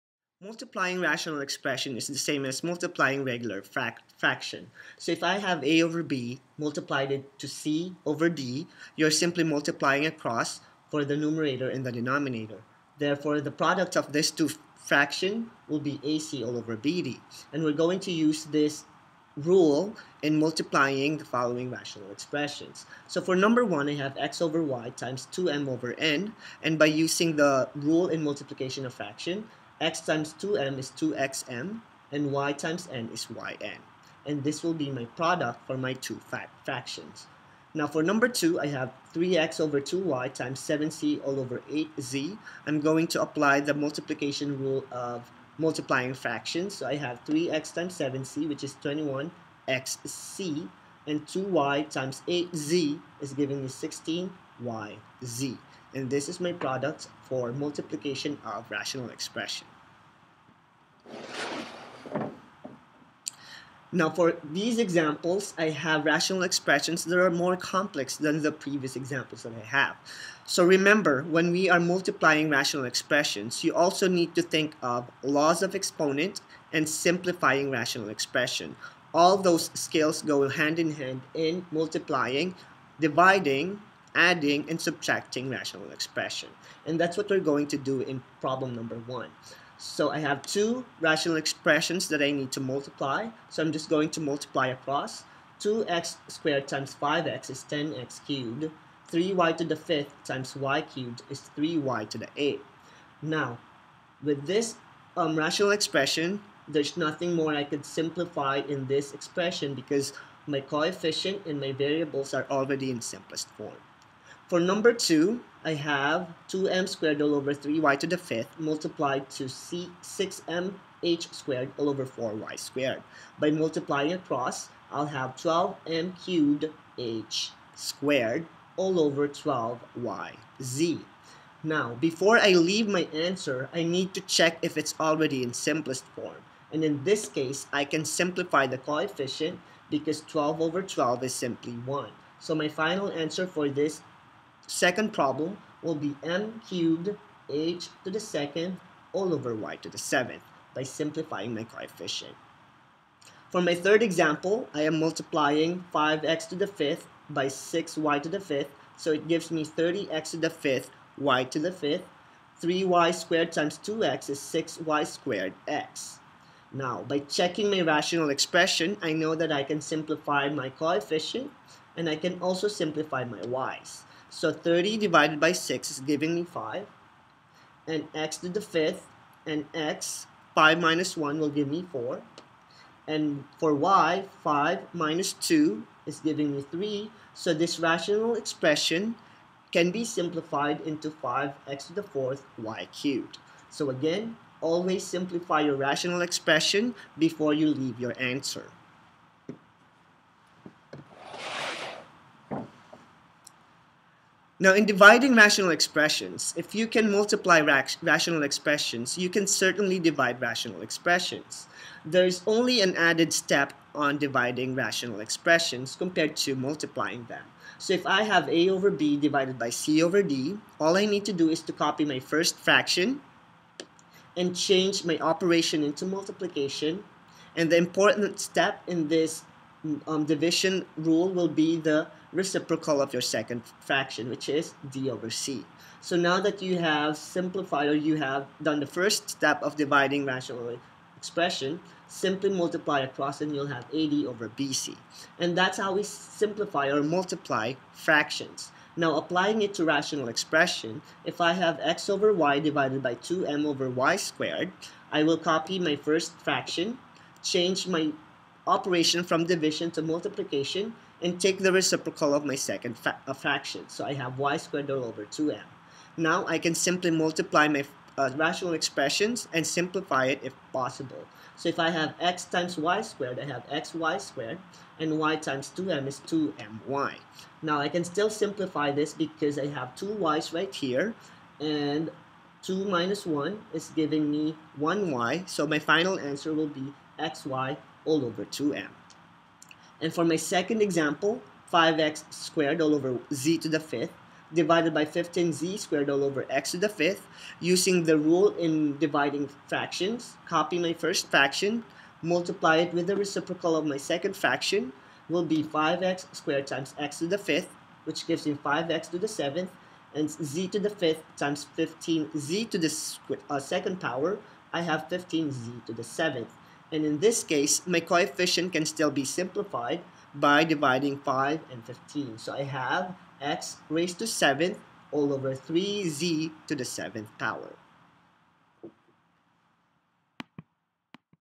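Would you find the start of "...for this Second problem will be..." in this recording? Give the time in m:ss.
2:23.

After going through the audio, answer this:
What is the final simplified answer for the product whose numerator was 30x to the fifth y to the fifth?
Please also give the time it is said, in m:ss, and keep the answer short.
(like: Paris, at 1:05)
5x^4y^3, at 3:11.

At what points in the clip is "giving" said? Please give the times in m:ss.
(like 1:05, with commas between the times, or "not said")
0:53, 2:55, 3:06, 4:43.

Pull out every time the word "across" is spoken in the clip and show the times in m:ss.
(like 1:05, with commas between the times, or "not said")
0:10, 1:34, 2:04, 4:03.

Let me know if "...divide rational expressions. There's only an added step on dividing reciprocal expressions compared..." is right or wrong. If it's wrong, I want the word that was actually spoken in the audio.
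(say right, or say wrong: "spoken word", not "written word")
wrong: "rational", not "reciprocal".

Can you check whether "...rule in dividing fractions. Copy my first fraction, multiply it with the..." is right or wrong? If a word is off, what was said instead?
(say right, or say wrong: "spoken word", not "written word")
right.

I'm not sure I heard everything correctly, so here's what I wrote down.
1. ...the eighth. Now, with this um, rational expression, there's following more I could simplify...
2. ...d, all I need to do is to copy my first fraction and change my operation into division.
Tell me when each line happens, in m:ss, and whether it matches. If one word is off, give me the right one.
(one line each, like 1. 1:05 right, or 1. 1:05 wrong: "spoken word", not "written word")
1. 1:42 wrong: "nothing", not "following"
2. 3:40 wrong: "multiplication", not "division".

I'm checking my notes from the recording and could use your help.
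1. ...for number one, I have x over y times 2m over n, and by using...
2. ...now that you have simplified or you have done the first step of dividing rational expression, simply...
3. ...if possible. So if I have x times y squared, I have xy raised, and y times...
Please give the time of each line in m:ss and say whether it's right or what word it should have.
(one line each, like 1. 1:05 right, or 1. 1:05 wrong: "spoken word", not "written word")
1. 0:23 right
2. 3:56 right
3. 4:30 wrong: "squared", not "raised".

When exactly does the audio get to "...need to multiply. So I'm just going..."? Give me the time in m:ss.
1:32.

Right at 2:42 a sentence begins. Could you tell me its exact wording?
3y squared times 2x is 6y squared x.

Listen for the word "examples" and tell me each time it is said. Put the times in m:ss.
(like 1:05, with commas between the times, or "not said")
1:04, 1:08, 2:34, 4:50.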